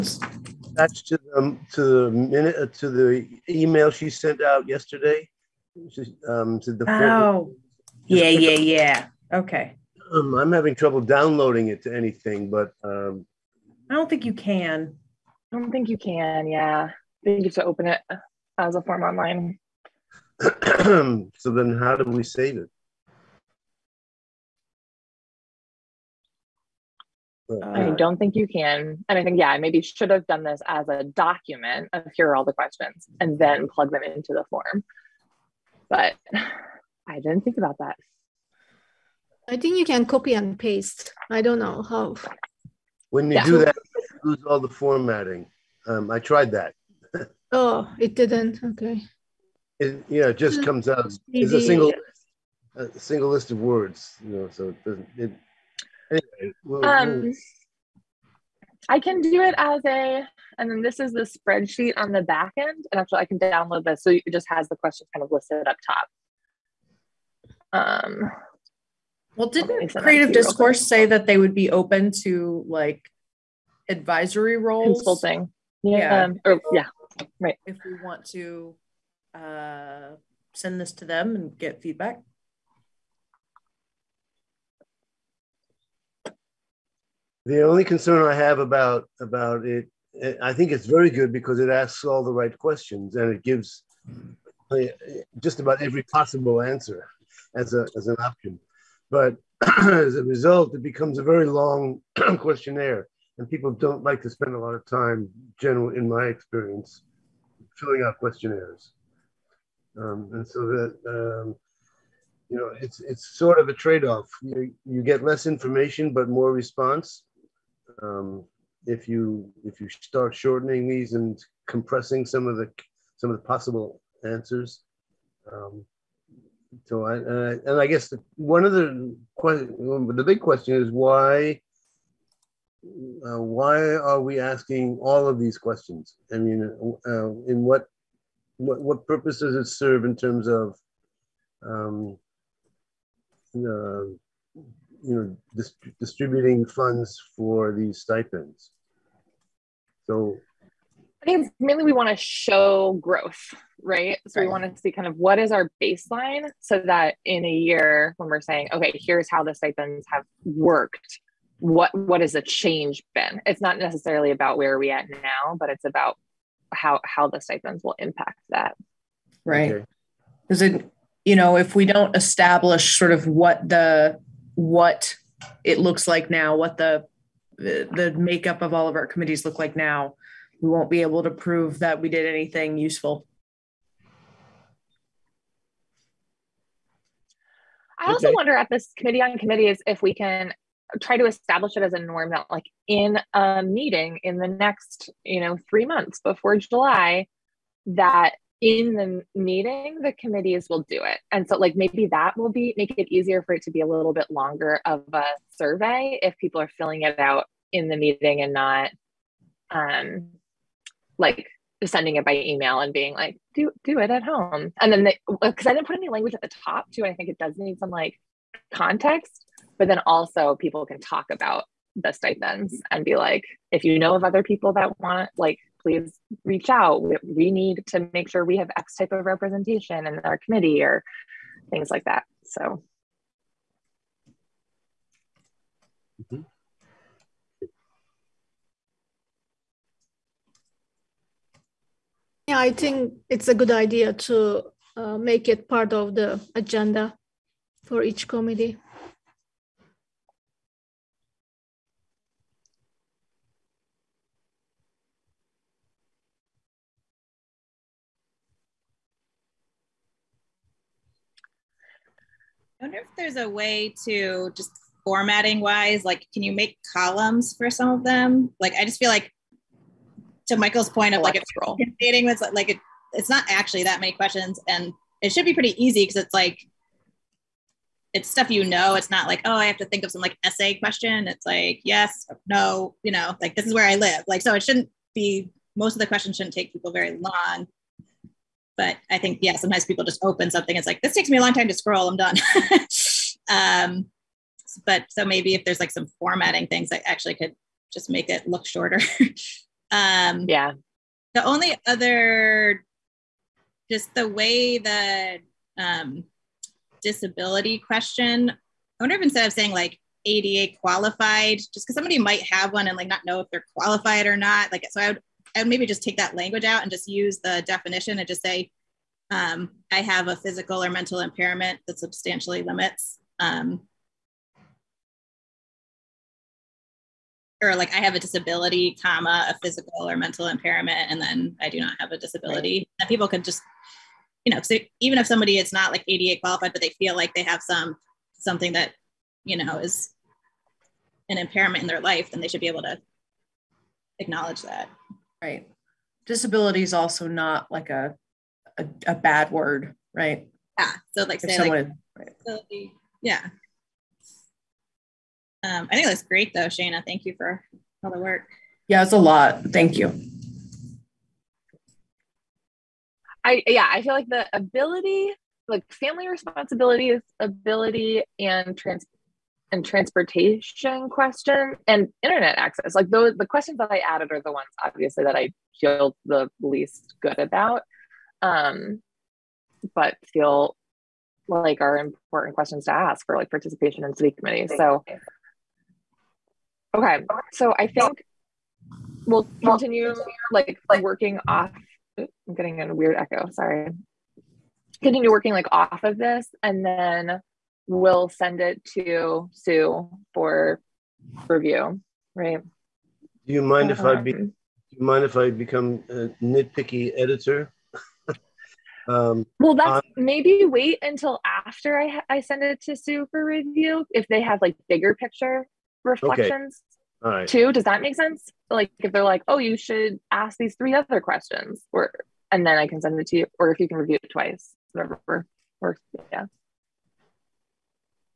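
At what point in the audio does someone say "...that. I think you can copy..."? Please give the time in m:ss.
0:37.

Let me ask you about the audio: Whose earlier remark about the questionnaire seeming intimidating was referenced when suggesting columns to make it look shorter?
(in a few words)
Michael.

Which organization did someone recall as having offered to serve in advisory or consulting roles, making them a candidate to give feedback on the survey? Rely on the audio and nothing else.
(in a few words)
Creative Discourse.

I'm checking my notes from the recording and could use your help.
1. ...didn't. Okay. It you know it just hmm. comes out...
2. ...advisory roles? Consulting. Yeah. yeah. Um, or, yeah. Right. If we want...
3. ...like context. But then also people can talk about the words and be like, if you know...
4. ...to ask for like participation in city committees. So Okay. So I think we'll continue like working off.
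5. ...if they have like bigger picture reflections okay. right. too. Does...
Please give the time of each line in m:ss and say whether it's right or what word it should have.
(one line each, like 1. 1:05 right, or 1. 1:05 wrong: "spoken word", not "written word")
1. 0:48 right
2. 1:13 right
3. 3:37 wrong: "stipends", not "words"
4. 6:22 right
5. 6:54 right.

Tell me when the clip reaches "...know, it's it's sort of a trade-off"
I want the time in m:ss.
1:52.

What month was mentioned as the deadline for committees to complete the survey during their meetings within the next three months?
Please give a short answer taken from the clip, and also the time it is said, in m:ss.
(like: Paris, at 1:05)
July, at 3:16.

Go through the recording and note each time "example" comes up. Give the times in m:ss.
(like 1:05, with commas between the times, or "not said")
not said.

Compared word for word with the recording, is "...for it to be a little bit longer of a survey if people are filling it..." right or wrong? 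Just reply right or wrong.
right.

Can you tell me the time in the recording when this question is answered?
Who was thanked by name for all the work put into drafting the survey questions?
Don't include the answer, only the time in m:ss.
5:56.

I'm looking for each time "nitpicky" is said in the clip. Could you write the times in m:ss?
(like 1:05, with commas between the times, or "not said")
6:46.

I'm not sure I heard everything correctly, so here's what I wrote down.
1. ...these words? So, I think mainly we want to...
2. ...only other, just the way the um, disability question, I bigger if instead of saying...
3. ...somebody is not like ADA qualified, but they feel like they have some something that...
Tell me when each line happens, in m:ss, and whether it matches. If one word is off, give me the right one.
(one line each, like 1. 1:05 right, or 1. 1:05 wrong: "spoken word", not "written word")
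1. 2:27 wrong: "stipends", not "words"
2. 5:01 wrong: "wonder", not "bigger"
3. 5:35 right.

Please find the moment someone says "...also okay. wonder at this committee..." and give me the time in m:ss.
3:08.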